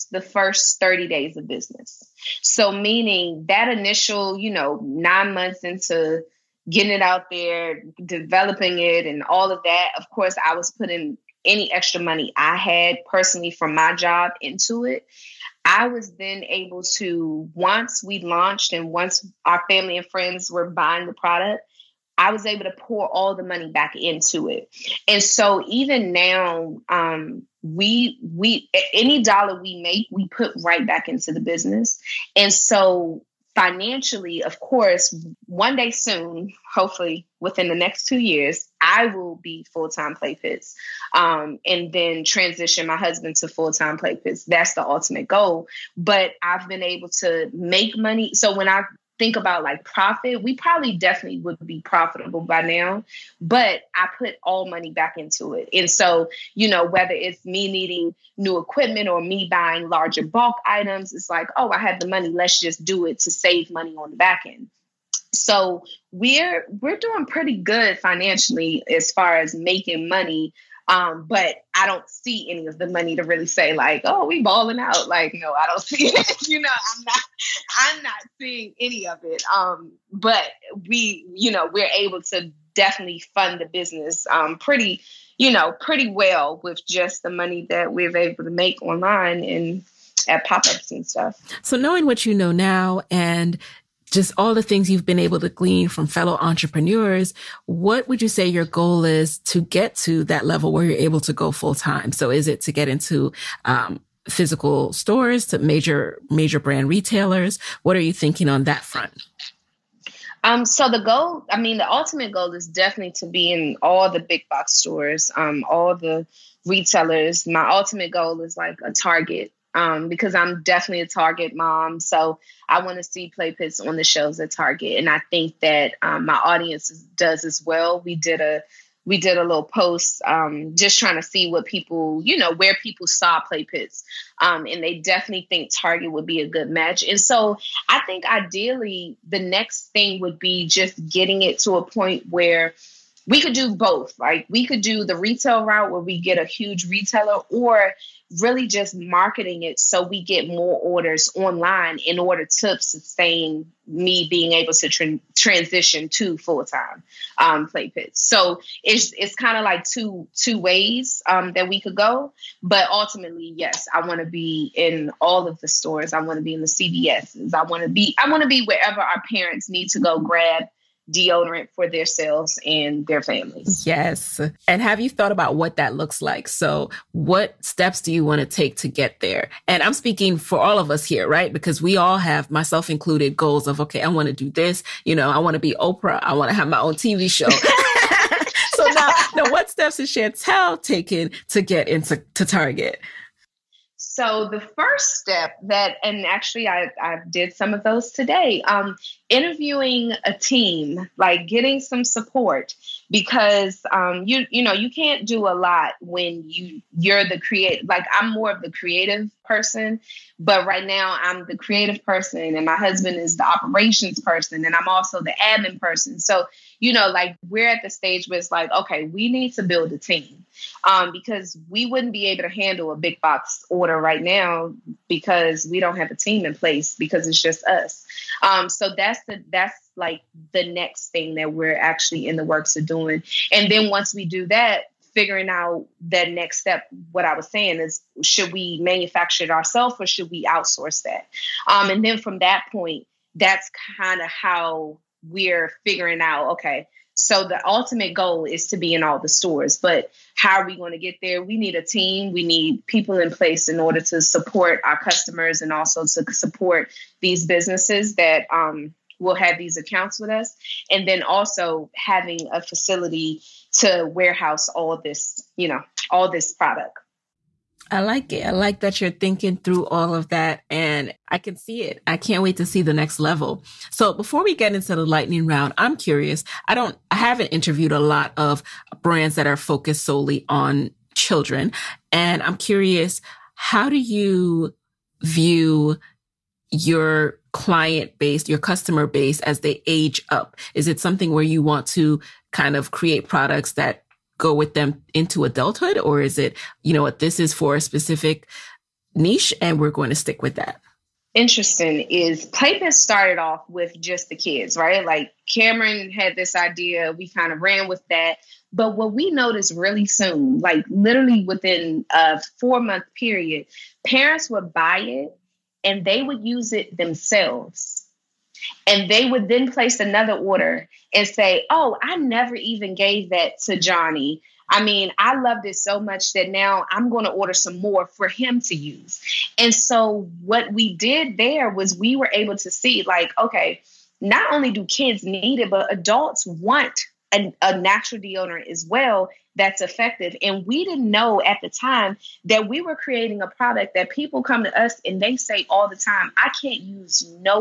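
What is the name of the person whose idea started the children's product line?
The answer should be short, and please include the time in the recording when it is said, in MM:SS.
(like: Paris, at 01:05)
Kameron, at 05:05.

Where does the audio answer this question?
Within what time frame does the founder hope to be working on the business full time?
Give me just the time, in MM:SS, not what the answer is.
00:38.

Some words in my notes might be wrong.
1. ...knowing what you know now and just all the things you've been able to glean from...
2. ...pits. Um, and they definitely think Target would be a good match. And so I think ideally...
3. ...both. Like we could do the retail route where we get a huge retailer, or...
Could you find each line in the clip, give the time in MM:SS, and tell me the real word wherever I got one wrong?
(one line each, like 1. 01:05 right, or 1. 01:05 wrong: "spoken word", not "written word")
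1. 01:31 right
2. 02:13 right
3. 02:23 right.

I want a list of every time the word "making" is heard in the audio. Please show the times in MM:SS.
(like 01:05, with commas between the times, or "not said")
01:09.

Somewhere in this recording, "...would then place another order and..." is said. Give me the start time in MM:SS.
05:19.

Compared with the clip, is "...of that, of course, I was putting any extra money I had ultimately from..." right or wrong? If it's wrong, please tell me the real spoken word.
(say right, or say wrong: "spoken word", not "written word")
wrong: "personally", not "ultimately".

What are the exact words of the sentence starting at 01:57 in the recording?
My ultimate goal is like a Target, um, because I'm definitely a Target mom.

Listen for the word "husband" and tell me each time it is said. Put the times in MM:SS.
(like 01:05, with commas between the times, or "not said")
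00:42, 03:32.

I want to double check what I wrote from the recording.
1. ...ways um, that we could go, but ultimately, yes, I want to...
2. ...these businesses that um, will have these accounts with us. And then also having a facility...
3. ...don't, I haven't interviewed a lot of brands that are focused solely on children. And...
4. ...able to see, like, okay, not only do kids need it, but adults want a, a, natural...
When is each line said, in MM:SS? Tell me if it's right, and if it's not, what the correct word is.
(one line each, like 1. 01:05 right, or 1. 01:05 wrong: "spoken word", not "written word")
1. 02:40 right
2. 04:17 right
3. 04:36 right
4. 05:32 right.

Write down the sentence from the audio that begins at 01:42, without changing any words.
So is it to get into um, physical stores, to major major brand retailers?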